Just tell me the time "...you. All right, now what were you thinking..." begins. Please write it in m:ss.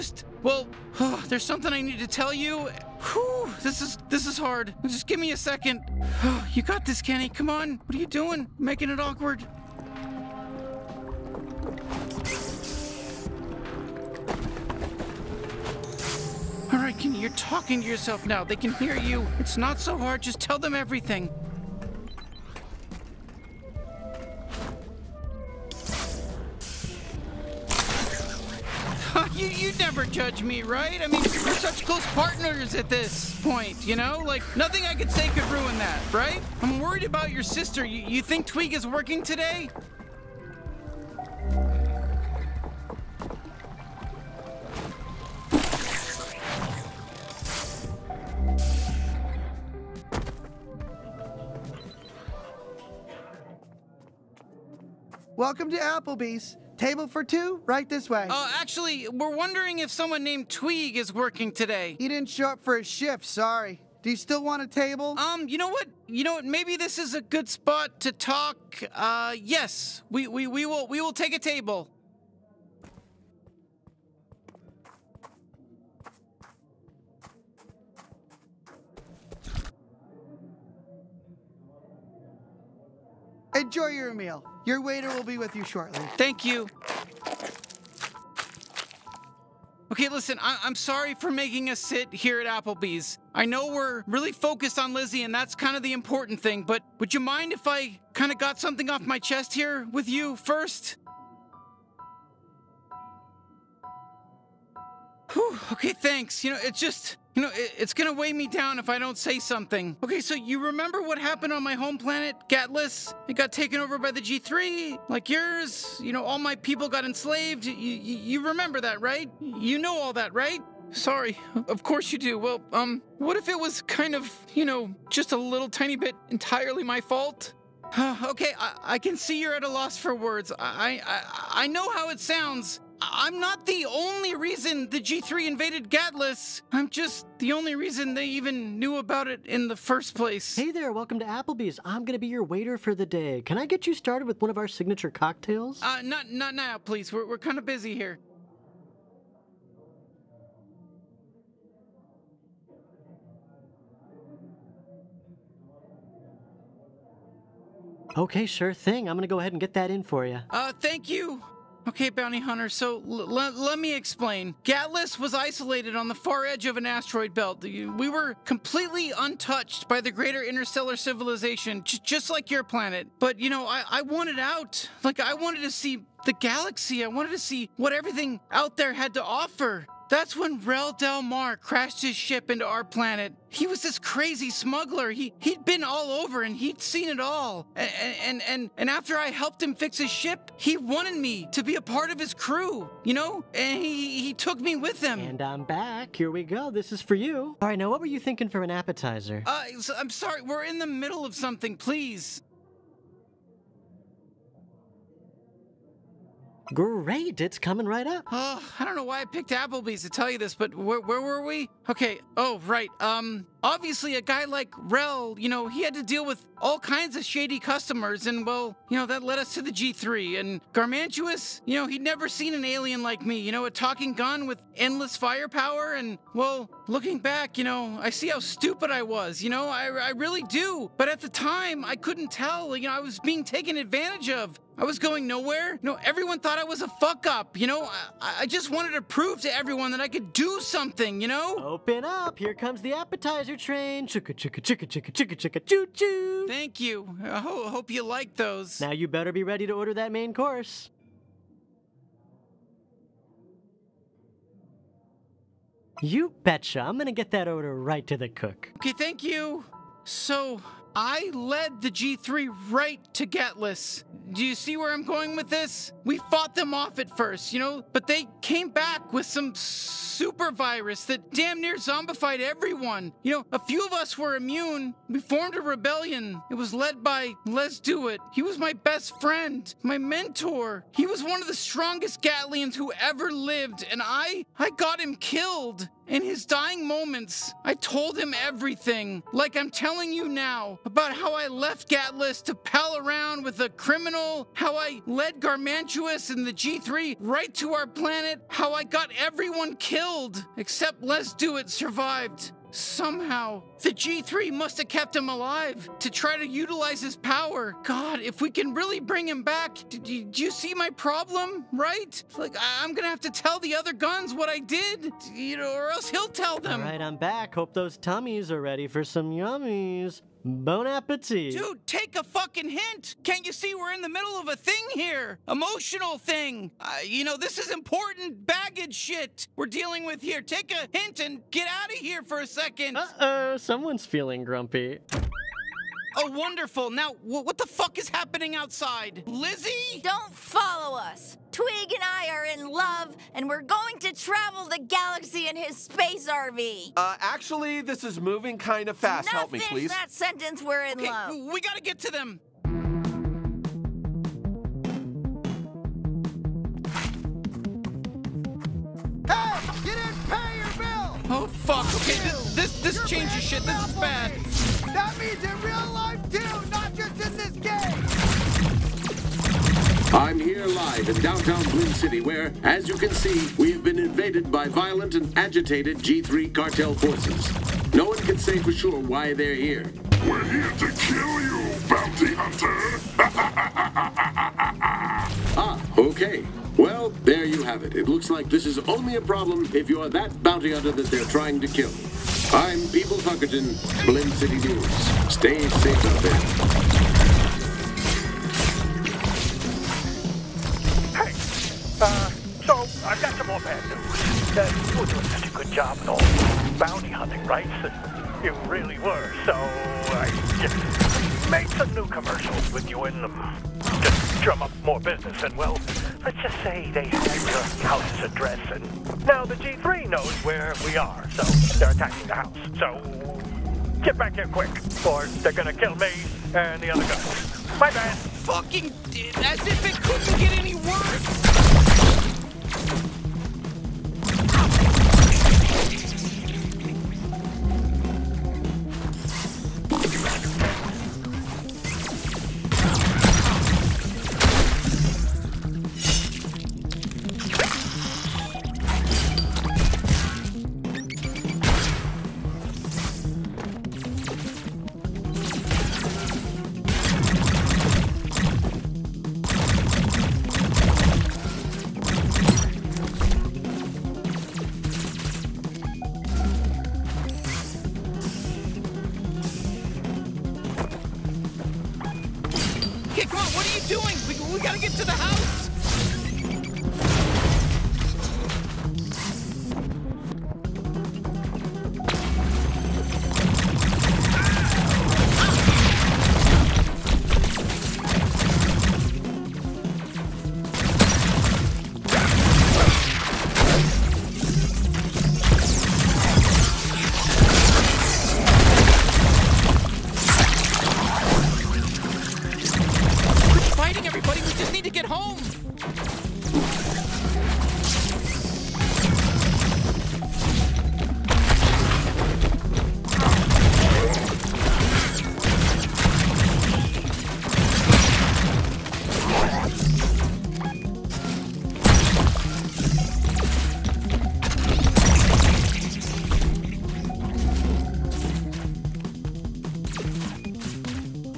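3:17.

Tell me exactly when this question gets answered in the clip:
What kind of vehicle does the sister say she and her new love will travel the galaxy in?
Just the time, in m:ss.
5:45.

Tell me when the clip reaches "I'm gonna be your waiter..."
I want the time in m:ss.
2:21.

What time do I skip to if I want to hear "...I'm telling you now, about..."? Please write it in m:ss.
4:49.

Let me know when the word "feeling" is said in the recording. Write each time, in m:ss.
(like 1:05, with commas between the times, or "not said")
5:34.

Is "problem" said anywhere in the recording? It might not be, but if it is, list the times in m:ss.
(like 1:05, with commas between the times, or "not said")
5:10, 6:29.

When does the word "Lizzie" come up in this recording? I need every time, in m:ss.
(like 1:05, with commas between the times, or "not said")
1:34, 5:39.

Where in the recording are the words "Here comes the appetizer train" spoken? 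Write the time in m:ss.
4:02.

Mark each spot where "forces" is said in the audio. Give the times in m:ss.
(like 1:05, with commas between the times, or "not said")
6:16.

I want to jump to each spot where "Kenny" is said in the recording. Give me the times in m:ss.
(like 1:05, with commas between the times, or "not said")
0:07, 0:16.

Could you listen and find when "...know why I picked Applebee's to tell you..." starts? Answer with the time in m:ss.
3:28.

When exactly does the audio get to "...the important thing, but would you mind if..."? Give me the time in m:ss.
1:35.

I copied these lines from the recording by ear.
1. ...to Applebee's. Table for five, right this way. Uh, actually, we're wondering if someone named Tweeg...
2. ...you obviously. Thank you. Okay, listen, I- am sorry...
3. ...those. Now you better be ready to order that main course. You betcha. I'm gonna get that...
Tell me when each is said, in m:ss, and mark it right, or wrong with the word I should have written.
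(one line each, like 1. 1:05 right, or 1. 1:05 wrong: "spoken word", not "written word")
1. 0:55 wrong: "two", not "five"
2. 1:25 wrong: "shortly", not "obviously"
3. 4:08 right.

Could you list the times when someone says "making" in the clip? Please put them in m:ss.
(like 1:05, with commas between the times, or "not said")
0:08, 1:31.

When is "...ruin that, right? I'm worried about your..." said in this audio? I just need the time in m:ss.
0:35.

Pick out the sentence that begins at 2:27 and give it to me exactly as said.
We're we're kind of busy here.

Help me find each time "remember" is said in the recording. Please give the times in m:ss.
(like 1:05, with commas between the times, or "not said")
1:50, 1:58.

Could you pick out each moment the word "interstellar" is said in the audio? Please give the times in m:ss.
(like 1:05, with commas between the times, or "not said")
2:50.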